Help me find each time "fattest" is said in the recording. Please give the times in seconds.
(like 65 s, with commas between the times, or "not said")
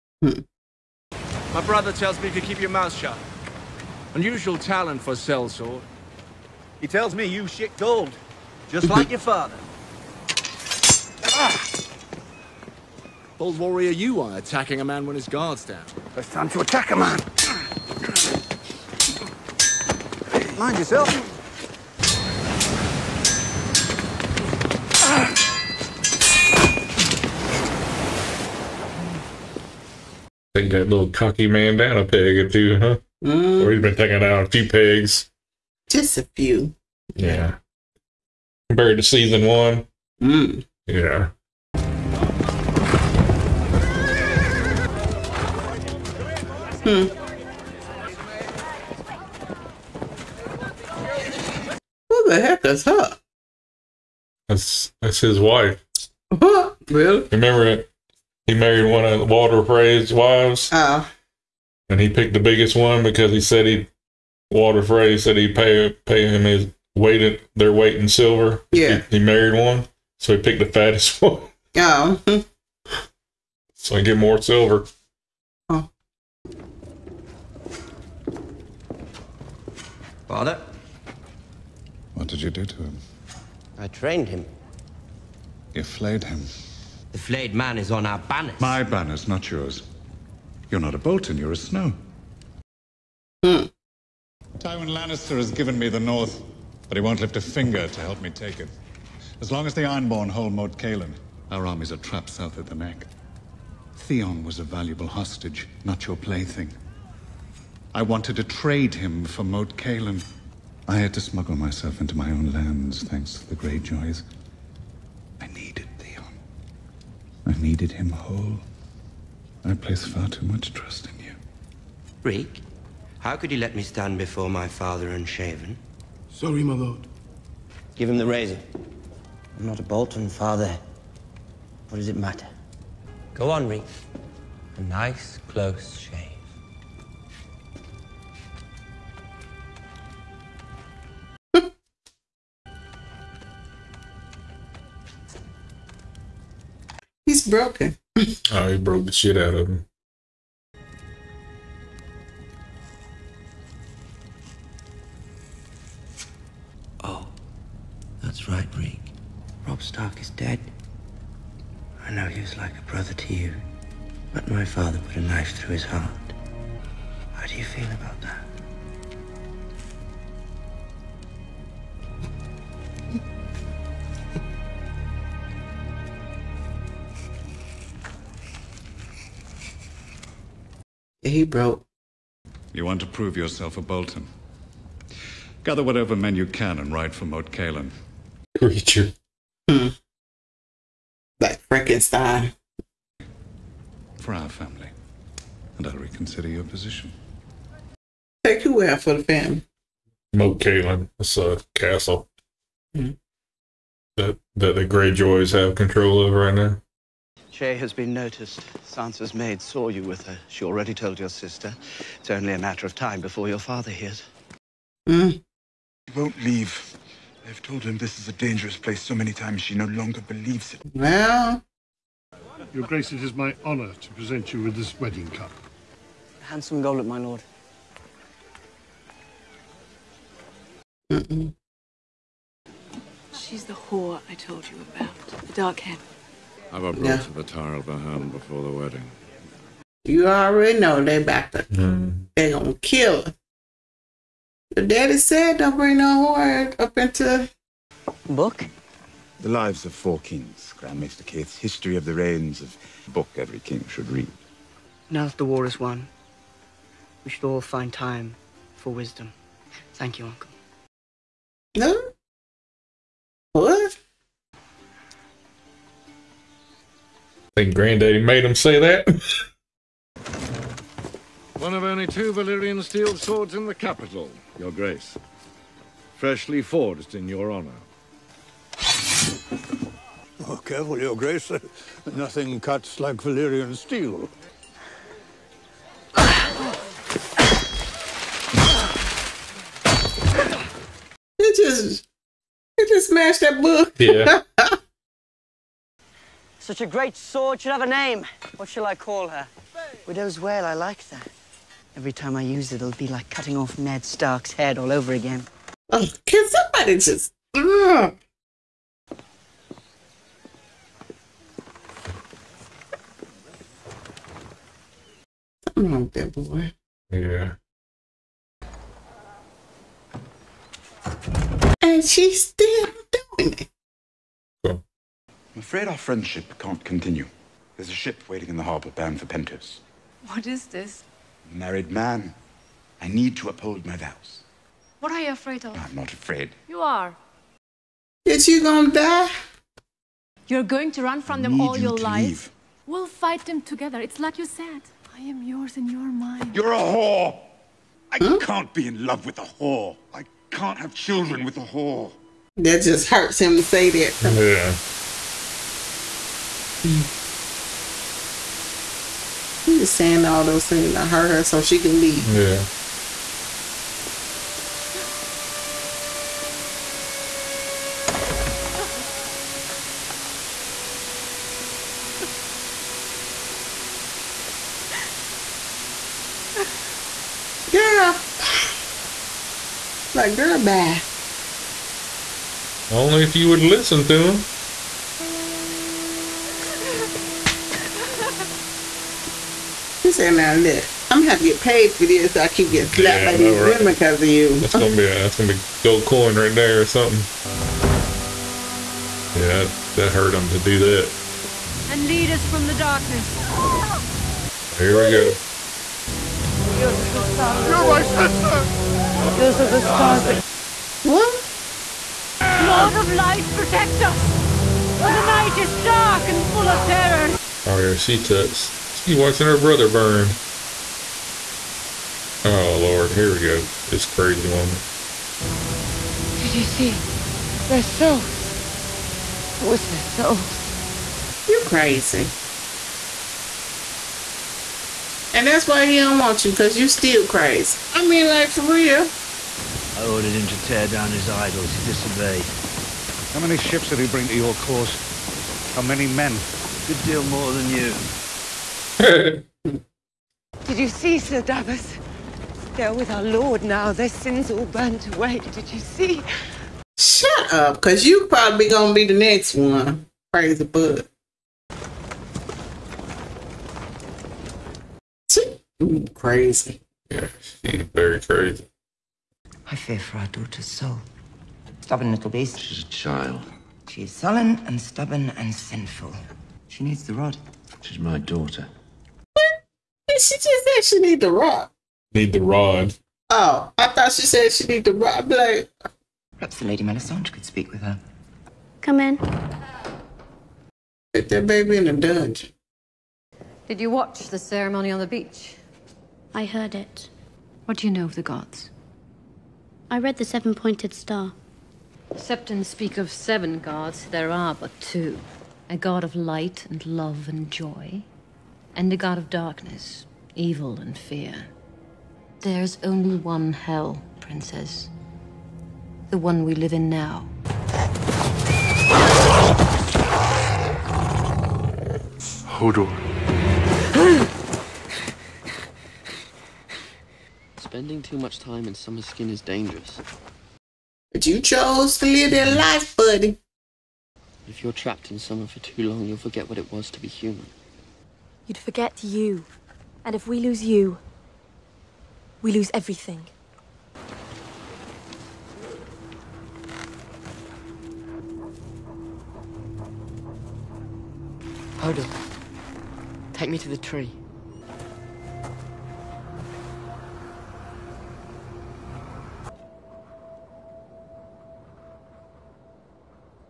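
70 s.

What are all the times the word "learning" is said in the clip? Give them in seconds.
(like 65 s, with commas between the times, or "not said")
not said.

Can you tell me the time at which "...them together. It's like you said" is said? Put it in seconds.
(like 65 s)
343 s.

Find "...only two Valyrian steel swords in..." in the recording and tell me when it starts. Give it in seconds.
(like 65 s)
271 s.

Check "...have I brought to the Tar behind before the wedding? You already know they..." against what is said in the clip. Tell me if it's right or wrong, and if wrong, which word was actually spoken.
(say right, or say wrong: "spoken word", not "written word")
right.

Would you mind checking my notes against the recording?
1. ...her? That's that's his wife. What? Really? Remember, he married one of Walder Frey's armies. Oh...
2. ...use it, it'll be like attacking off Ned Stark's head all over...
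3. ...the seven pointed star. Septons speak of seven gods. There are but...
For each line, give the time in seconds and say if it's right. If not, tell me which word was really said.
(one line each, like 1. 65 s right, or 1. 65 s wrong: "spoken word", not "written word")
1. 52 s wrong: "wives", not "armies"
2. 302 s wrong: "cutting", not "attacking"
3. 500 s right.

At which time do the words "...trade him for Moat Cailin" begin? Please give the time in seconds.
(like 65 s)
108 s.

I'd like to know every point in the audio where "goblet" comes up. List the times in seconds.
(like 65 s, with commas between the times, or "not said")
226 s.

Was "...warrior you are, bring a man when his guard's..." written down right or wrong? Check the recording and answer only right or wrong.
wrong.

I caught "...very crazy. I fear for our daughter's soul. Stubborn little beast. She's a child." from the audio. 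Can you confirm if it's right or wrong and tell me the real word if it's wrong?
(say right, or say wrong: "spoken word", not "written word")
right.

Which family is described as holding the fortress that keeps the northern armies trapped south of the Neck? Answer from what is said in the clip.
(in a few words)
The Ironborn.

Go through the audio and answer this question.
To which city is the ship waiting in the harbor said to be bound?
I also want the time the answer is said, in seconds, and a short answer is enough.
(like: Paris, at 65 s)
Pentos, at 329 s.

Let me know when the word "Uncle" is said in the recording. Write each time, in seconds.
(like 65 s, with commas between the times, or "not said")
260 s.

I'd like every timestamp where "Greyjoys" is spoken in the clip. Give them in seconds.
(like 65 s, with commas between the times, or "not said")
113 s, 204 s.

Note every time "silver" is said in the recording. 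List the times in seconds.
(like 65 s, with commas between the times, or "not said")
68 s, 74 s.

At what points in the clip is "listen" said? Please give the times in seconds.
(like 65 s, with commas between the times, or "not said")
383 s.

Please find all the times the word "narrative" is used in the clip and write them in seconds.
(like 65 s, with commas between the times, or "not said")
not said.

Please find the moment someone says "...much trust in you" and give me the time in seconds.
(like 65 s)
120 s.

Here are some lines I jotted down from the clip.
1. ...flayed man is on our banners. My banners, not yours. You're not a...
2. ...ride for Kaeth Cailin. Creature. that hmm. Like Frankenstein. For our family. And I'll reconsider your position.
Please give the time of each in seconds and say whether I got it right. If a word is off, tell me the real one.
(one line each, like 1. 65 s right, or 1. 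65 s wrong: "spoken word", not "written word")
1. 87 s right
2. 186 s wrong: "Moat", not "Kaeth".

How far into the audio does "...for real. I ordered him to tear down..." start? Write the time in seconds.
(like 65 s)
438 s.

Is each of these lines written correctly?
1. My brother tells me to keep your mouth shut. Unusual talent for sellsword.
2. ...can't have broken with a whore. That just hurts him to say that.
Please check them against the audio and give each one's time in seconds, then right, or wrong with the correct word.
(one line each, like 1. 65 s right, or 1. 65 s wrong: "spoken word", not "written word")
1. 1 s right
2. 350 s wrong: "children", not "broken".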